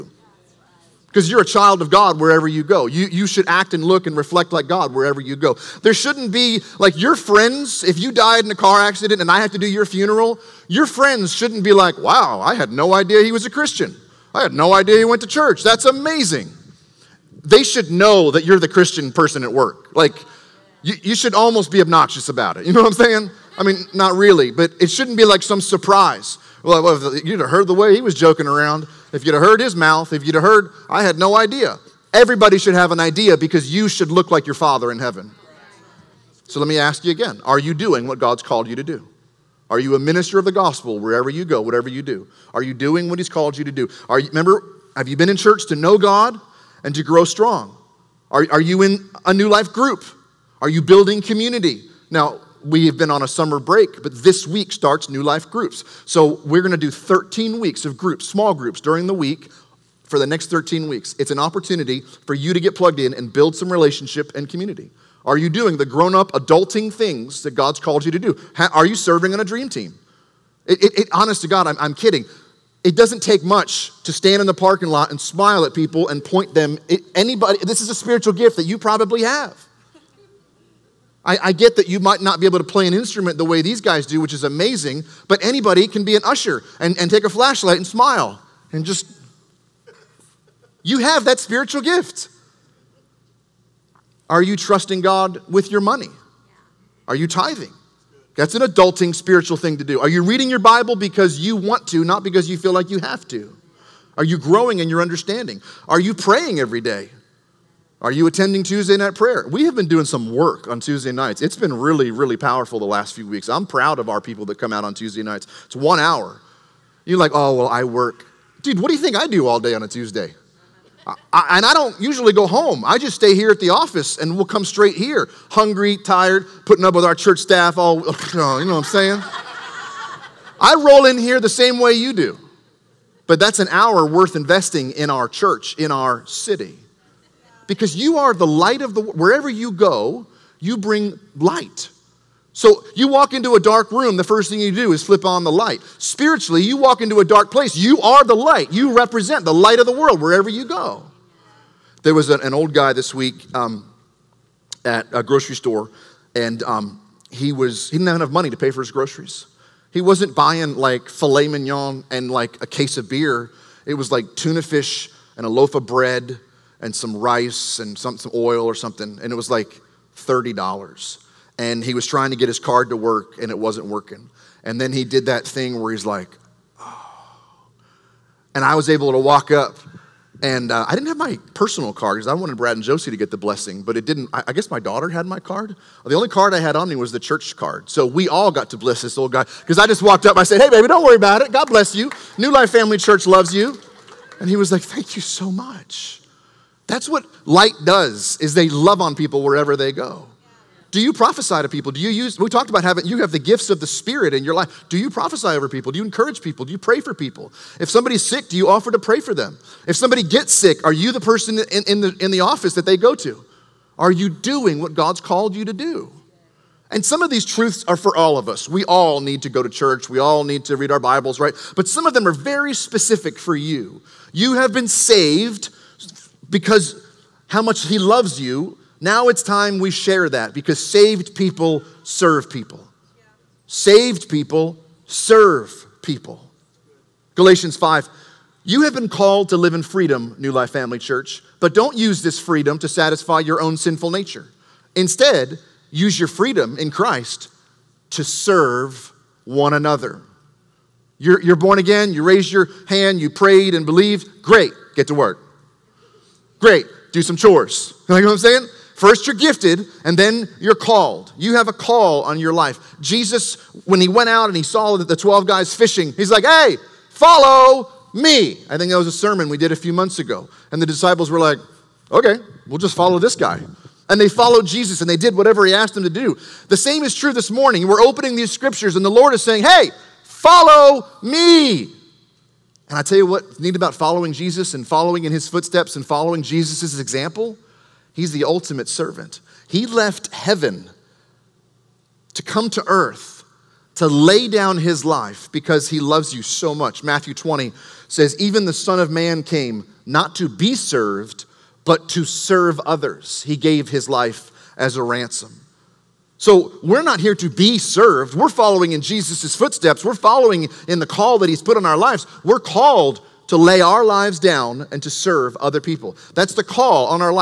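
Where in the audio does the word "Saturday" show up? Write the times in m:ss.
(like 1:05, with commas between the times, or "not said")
not said.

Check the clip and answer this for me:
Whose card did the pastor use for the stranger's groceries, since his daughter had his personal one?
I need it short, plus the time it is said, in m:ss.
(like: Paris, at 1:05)
The church card, at 3:07.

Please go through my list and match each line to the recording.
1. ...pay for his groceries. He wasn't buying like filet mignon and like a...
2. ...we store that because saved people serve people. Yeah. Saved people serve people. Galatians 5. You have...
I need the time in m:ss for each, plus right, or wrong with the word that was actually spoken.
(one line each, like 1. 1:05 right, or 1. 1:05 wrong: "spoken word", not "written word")
1. 2:38 right
2. 3:49 wrong: "share", not "store".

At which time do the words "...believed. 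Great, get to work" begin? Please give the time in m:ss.
4:13.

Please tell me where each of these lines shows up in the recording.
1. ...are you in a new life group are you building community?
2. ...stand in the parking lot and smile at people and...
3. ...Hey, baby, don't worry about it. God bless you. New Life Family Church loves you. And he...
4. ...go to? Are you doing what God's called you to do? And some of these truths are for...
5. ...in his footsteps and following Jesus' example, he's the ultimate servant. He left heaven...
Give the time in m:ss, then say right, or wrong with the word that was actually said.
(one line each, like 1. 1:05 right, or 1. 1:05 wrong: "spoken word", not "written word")
1. 0:48 right
2. 1:14 right
3. 3:10 right
4. 3:32 right
5. 4:45 right.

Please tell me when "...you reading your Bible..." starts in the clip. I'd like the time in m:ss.
1:40.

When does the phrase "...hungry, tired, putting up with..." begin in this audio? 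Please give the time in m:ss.
2:05.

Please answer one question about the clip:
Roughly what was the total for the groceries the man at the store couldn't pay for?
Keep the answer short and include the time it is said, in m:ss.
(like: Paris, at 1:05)
$30, at 2:50.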